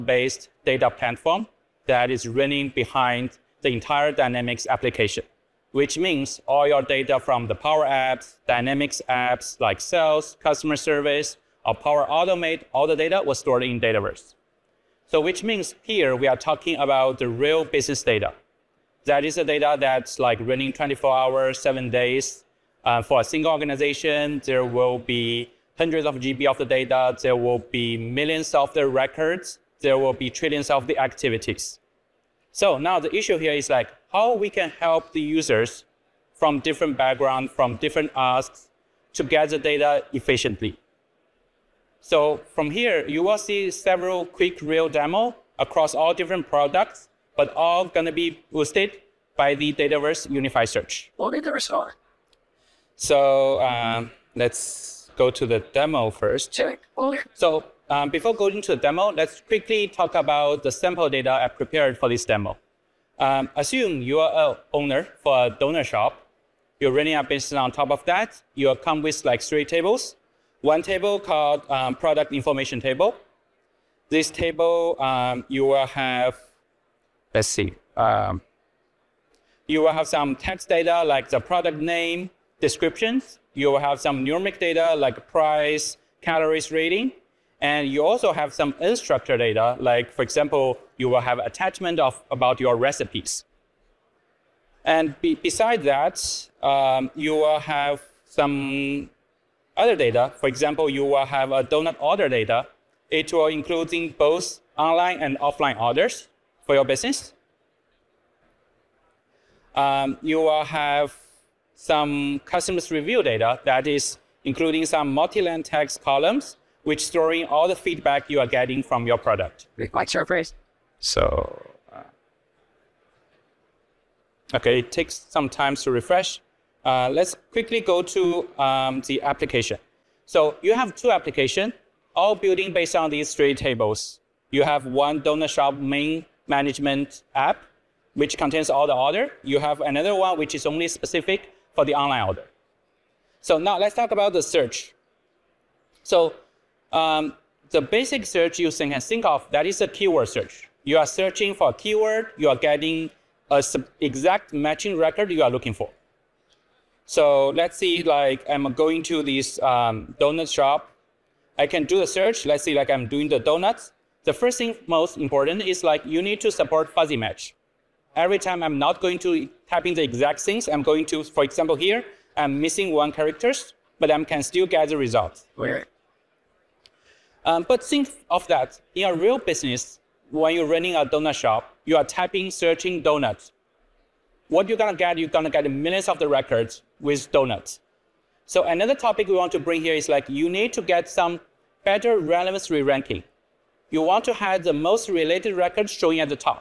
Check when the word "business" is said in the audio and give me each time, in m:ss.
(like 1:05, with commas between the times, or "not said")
0:17, 1:07, 1:46, 2:59.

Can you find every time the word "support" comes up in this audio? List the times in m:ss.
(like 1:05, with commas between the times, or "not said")
2:46.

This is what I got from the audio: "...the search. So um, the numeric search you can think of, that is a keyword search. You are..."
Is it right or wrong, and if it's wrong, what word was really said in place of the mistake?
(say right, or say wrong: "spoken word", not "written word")
wrong: "basic", not "numeric".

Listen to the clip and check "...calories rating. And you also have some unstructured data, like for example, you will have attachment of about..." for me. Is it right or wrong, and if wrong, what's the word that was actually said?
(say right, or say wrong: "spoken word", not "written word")
right.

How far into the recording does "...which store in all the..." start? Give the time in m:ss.
1:56.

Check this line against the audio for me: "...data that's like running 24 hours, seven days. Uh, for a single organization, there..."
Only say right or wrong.
right.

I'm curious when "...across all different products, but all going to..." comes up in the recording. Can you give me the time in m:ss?
0:45.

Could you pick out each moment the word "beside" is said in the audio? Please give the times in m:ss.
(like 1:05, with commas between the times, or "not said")
1:35.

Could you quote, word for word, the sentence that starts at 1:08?
you come with like three tables one table called um, product information table.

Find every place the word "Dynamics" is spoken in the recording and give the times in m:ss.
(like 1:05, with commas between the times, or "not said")
0:04, 0:08.